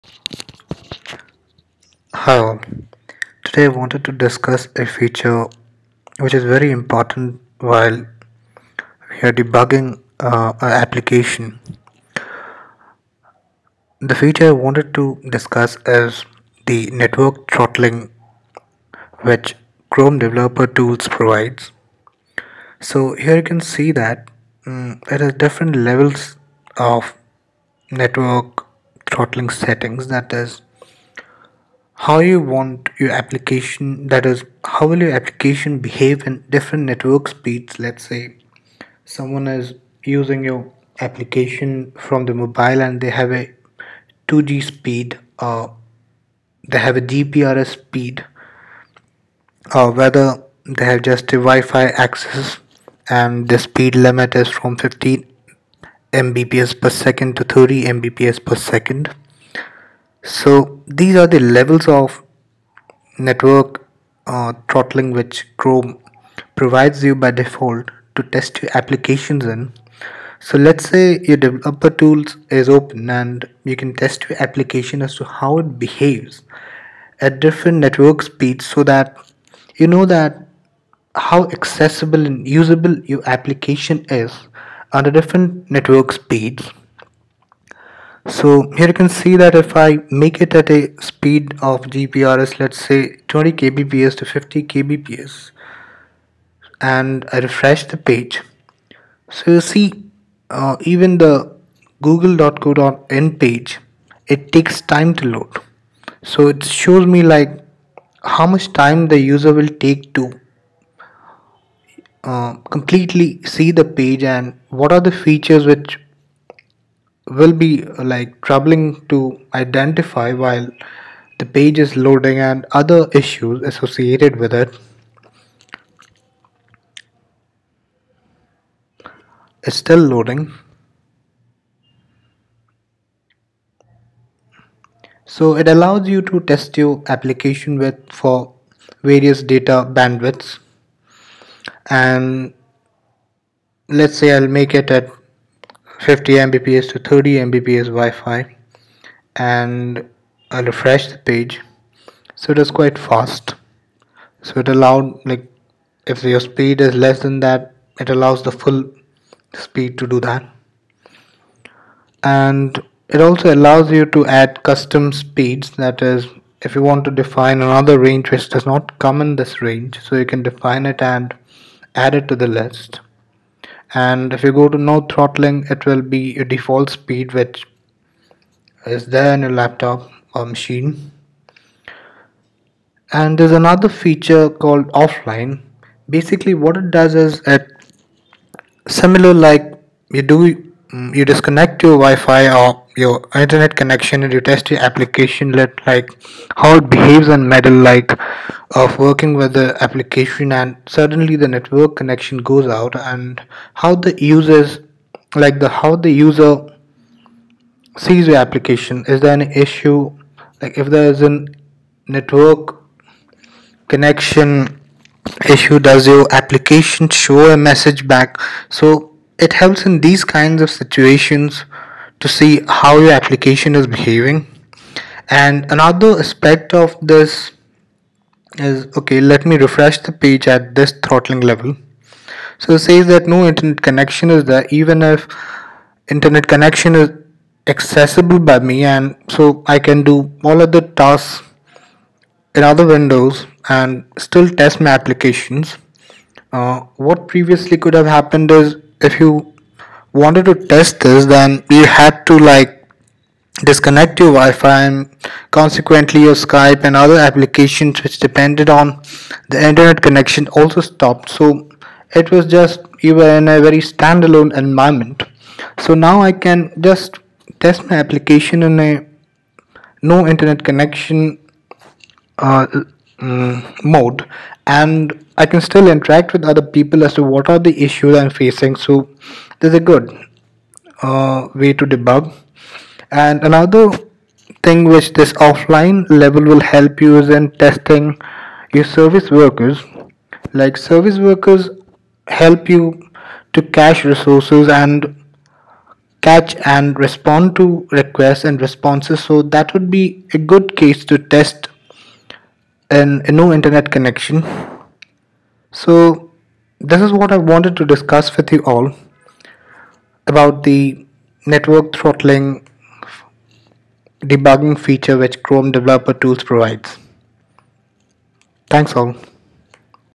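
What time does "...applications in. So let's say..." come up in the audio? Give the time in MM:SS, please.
01:08.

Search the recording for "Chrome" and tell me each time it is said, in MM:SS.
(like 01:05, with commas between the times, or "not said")
00:19, 01:05, 05:15.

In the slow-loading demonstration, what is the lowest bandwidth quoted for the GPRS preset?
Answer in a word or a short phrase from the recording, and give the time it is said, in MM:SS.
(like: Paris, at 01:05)
20 kbps, at 01:33.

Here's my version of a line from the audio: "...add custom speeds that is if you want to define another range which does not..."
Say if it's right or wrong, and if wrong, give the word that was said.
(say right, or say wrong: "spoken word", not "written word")
right.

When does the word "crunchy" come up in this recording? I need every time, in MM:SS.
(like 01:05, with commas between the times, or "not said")
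not said.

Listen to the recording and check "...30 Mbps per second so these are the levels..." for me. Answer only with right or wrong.
right.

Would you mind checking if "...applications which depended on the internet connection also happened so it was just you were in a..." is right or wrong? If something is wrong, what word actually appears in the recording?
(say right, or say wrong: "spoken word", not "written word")
wrong: "stopped", not "happened".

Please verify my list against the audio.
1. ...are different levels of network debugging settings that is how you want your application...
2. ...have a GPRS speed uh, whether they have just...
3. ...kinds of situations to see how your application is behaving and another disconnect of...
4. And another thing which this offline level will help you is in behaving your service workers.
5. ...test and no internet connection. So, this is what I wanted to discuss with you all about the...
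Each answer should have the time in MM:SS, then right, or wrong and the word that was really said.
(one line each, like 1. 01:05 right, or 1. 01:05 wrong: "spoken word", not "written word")
1. 00:25 wrong: "throttling", not "debugging"
2. 00:46 right
3. 03:40 wrong: "aspect", not "disconnect"
4. 04:43 wrong: "testing", not "behaving"
5. 05:01 right.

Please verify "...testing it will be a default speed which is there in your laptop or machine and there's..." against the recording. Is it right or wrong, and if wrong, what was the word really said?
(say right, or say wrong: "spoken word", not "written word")
wrong: "throttling", not "testing".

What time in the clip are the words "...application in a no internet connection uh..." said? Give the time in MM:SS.
04:27.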